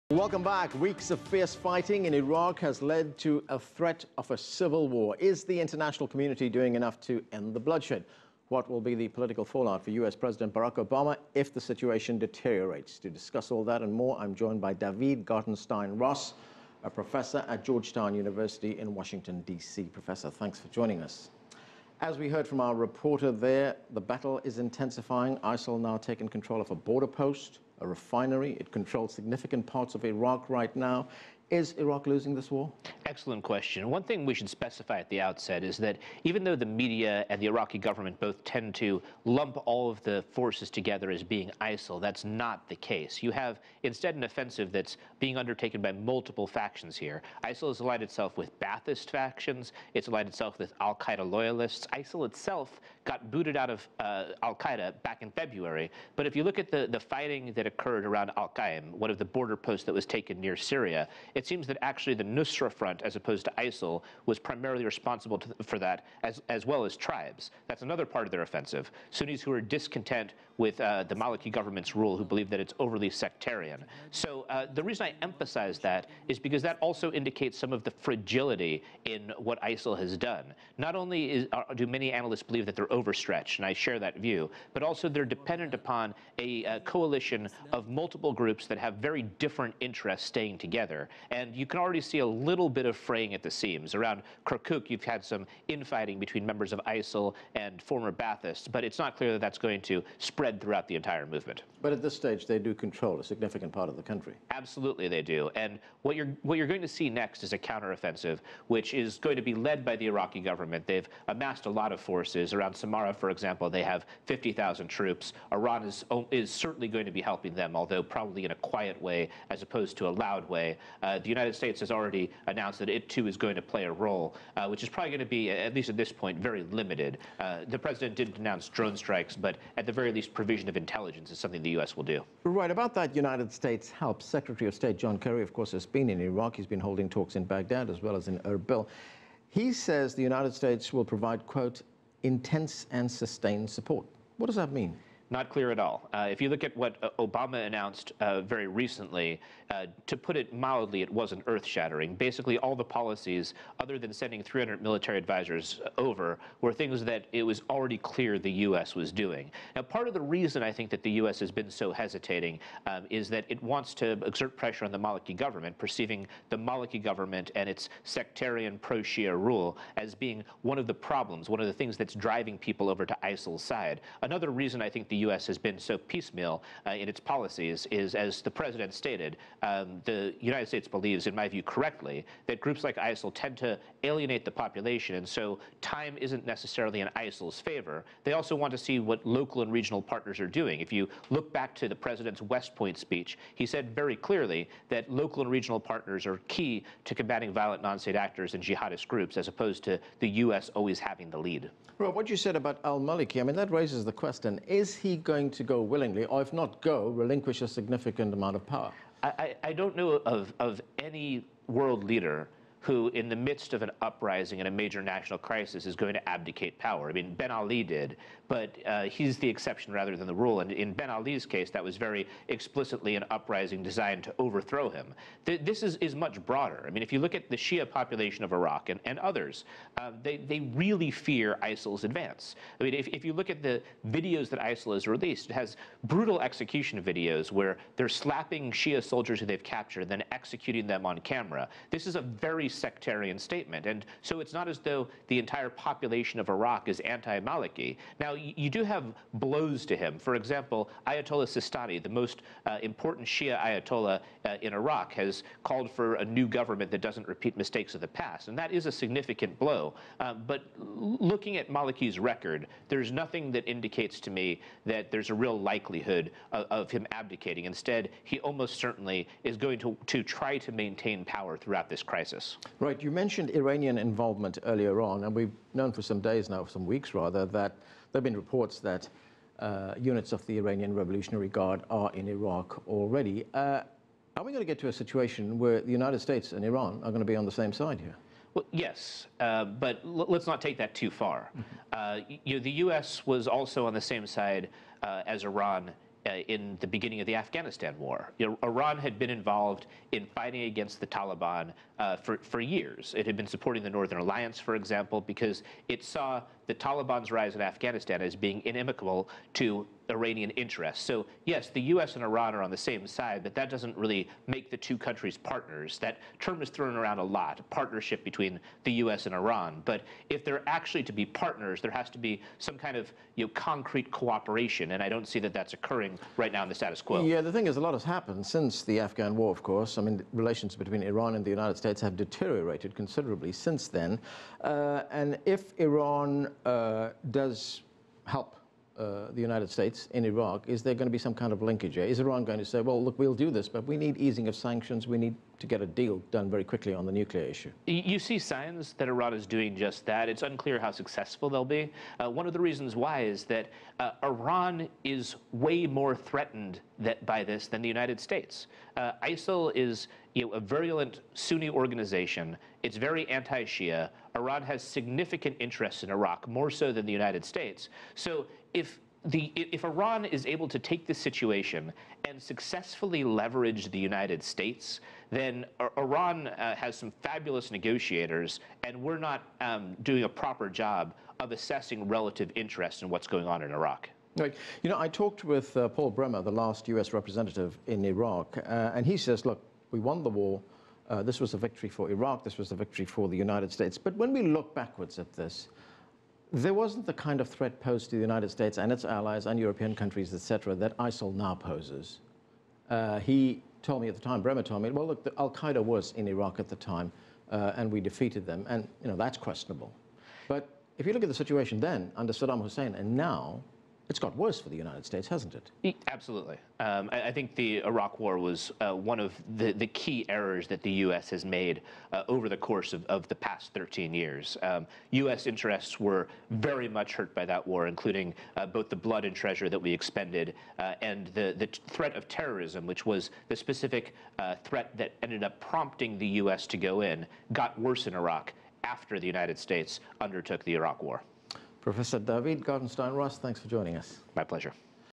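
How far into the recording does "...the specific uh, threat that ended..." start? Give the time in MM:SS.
07:13.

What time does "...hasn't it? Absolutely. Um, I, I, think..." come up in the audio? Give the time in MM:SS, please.
06:55.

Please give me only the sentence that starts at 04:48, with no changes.
Well, yes, uh, but let's not take that too far.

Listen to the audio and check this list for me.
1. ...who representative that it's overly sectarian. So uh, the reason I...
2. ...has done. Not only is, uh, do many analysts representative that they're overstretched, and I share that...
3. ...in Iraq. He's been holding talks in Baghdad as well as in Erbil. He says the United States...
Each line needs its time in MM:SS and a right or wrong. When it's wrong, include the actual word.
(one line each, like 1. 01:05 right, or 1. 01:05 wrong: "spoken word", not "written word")
1. 01:12 wrong: "believe", not "representative"
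2. 01:19 wrong: "believe", not "representative"
3. 02:16 right.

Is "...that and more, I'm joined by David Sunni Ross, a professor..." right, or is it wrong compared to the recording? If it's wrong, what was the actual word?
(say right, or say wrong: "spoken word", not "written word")
wrong: "Gartenstein", not "Sunni".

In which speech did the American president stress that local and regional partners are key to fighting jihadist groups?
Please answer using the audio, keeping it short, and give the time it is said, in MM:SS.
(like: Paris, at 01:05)
West Point speech, at 03:12.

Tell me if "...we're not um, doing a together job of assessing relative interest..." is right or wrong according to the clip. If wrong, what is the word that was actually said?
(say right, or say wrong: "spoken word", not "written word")
wrong: "proper", not "together".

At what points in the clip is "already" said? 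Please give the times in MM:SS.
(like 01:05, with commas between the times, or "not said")
01:31, 02:01, 02:37, 04:42.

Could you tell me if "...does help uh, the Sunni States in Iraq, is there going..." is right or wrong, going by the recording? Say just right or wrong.
wrong.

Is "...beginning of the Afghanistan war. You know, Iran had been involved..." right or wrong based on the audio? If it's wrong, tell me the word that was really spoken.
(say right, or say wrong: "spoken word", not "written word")
right.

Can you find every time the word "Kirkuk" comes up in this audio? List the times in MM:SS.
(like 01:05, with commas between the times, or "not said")
01:34.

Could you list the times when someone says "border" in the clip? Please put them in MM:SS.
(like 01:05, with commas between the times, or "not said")
00:26, 00:59.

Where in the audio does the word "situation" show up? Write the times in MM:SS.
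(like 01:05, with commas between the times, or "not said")
00:11, 04:44, 06:11, 06:51.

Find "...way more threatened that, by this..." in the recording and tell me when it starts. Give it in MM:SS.
05:55.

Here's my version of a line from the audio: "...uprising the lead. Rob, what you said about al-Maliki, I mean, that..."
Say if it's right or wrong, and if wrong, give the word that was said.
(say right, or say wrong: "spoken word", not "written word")
wrong: "having", not "uprising".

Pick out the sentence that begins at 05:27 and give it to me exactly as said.
Yeah, the thing is, a lot has happened since the Afghan war, of course.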